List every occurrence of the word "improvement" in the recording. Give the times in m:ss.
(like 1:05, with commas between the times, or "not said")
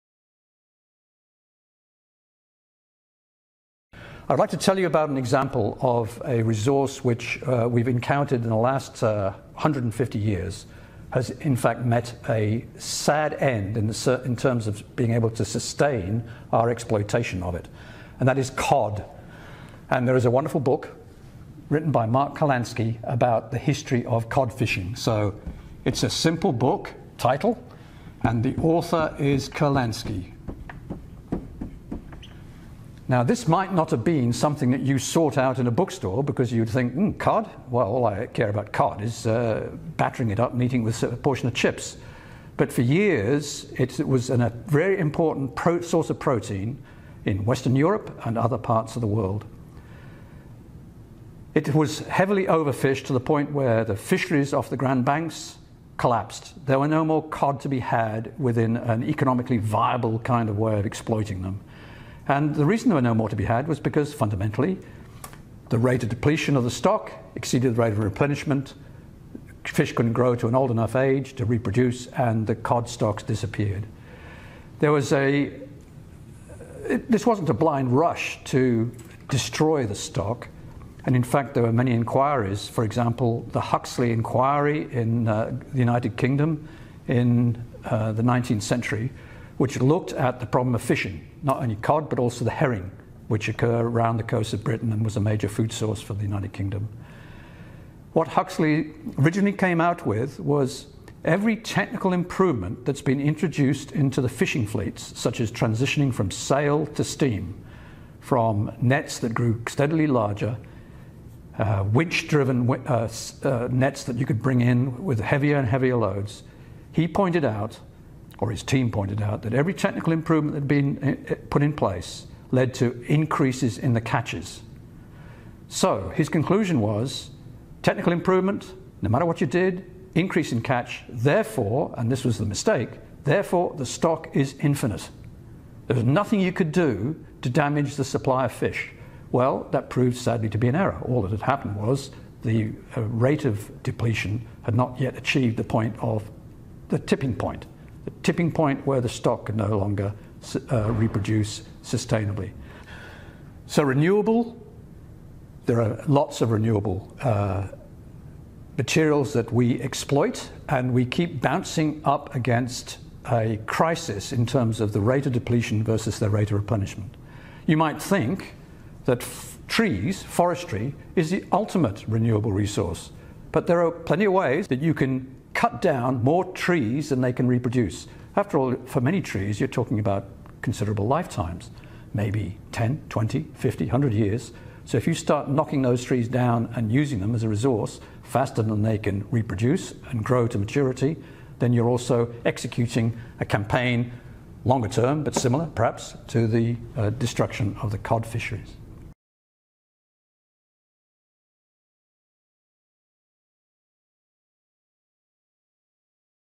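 1:42, 2:00, 2:08.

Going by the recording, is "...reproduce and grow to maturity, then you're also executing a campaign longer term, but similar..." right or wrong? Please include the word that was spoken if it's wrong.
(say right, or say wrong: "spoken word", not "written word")
right.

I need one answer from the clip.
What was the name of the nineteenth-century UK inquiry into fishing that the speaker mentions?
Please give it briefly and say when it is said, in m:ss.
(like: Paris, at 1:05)
Huxley inquiry, at 1:23.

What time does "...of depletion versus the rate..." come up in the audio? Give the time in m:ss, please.
2:45.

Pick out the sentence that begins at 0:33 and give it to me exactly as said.
Now, this might not have been something that you sought out in a bookstore because you'd think, mm, cod?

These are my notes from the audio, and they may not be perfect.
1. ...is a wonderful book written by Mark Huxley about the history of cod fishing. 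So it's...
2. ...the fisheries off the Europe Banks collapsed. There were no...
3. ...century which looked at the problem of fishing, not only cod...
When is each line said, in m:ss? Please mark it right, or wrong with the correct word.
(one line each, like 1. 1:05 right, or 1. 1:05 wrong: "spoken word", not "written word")
1. 0:20 wrong: "Kurlansky", not "Huxley"
2. 0:53 wrong: "Grand", not "Europe"
3. 1:28 right.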